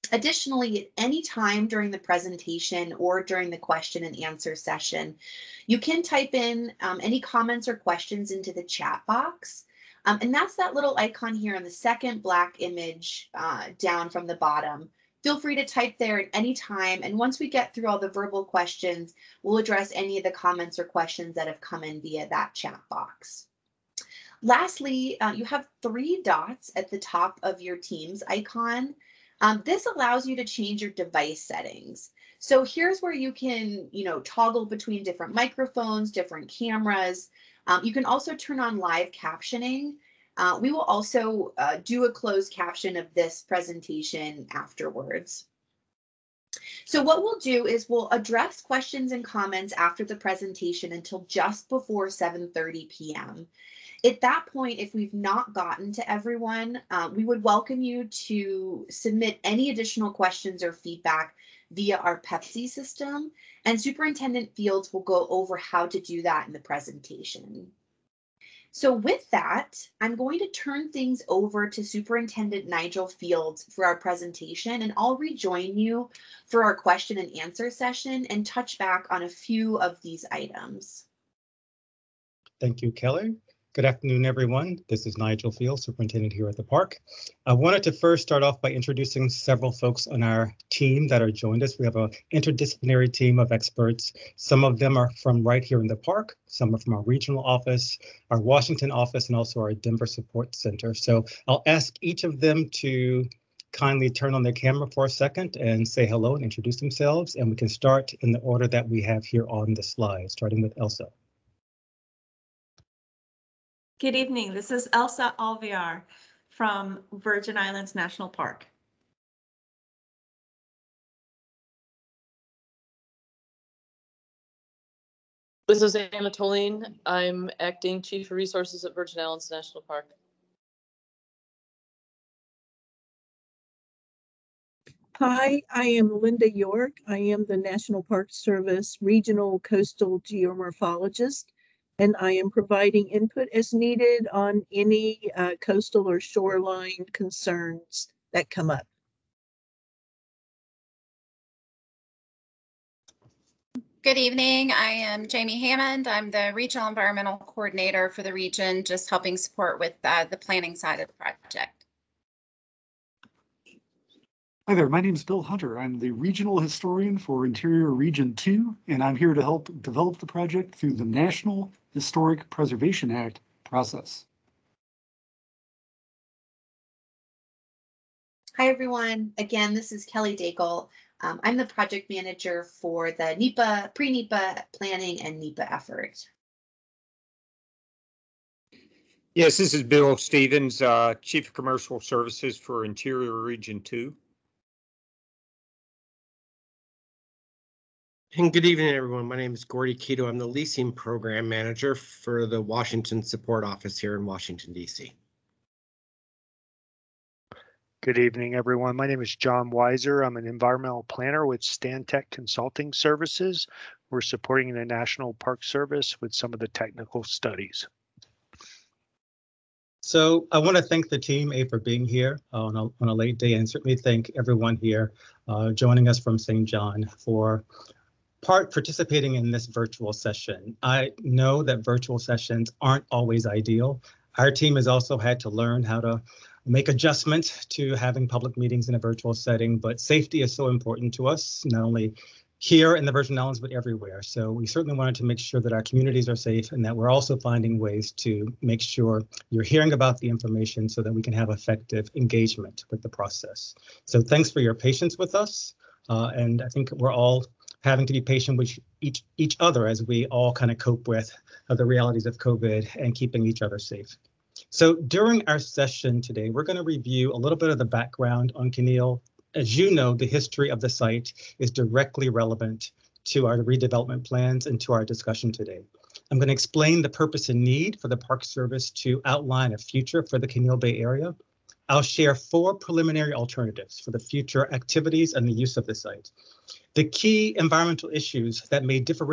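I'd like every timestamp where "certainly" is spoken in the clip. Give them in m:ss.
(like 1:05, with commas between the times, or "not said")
3:43, 4:04.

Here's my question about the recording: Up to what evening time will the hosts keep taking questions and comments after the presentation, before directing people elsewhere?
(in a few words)
7:30 p.m.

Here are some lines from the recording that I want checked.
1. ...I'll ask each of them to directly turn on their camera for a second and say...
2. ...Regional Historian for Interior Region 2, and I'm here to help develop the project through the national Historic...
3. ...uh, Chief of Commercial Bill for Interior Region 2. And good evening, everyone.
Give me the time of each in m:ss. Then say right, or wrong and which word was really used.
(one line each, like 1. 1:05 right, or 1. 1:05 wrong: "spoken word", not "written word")
1. 1:41 wrong: "kindly", not "directly"
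2. 2:46 right
3. 3:10 wrong: "Services", not "Bill".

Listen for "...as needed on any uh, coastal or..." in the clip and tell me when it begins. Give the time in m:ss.
2:23.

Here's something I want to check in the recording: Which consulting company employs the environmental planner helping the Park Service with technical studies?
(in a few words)
Stantec Consulting Services.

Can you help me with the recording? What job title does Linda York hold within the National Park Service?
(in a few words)
Regional Coastal Geomorphologist.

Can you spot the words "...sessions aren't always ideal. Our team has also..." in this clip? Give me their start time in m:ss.
3:52.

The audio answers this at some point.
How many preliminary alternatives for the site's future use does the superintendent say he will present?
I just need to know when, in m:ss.
4:42.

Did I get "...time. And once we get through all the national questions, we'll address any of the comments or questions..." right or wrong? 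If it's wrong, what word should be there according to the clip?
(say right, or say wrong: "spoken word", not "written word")
wrong: "verbal", not "national".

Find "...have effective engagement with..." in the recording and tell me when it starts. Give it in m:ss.
4:11.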